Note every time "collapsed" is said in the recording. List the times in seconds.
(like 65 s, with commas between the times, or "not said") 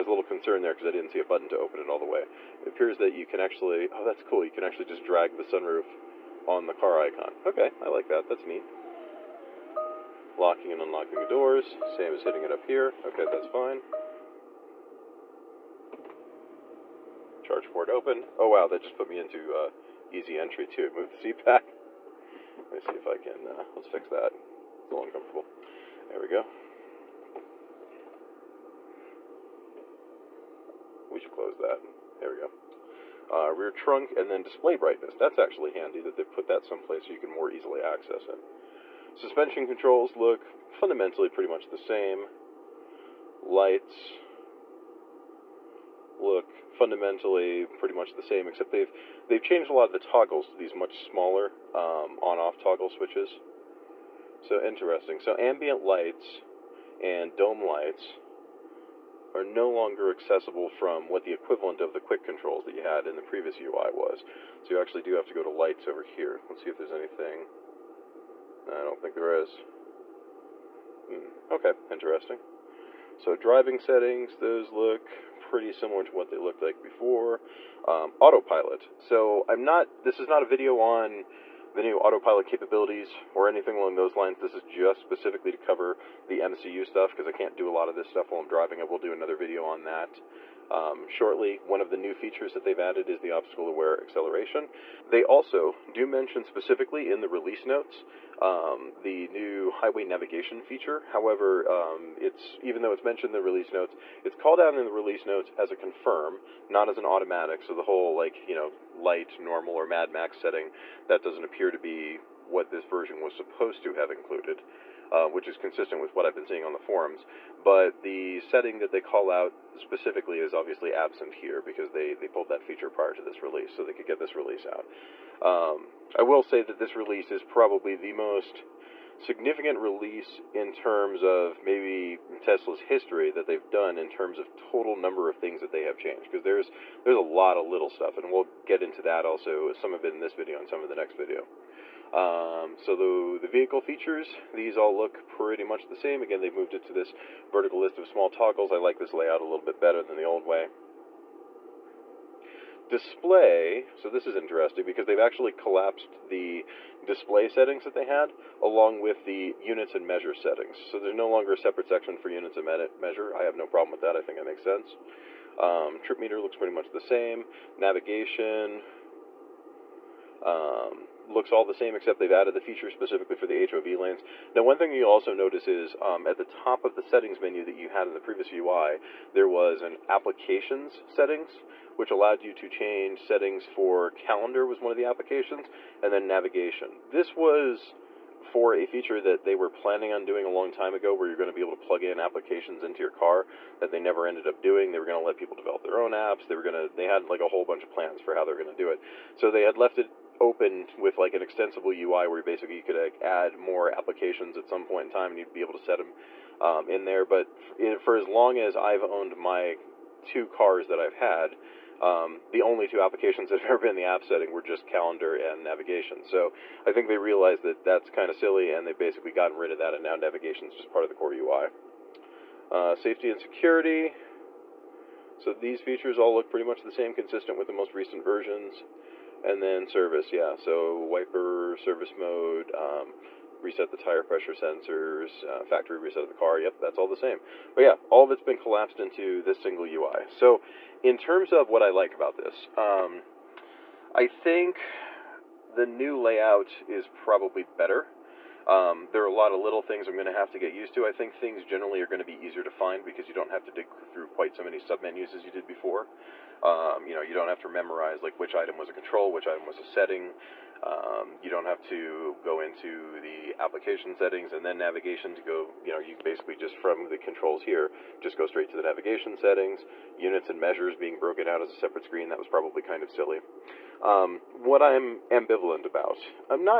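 155 s, 238 s.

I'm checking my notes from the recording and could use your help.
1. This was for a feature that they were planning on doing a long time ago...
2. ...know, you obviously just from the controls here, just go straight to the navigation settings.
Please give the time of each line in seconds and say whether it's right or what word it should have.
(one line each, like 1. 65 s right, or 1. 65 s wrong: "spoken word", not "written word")
1. 187 s right
2. 265 s wrong: "basically", not "obviously".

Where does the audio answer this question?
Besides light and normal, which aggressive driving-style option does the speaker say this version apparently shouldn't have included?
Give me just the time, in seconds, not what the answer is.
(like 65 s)
109 s.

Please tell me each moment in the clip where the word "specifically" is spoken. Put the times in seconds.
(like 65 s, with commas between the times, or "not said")
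85 s, 96 s, 119 s, 172 s.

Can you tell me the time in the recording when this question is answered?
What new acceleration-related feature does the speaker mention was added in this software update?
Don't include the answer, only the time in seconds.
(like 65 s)
93 s.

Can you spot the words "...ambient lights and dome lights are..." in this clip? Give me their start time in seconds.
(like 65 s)
55 s.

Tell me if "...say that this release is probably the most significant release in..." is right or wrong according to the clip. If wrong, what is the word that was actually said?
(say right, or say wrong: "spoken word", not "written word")
right.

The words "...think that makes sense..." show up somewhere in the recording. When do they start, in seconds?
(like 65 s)
164 s.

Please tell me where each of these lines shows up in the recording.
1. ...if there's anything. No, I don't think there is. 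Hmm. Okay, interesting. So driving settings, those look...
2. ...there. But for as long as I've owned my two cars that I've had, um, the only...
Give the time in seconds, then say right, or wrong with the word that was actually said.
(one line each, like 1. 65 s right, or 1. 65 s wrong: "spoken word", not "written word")
1. 66 s right
2. 207 s right.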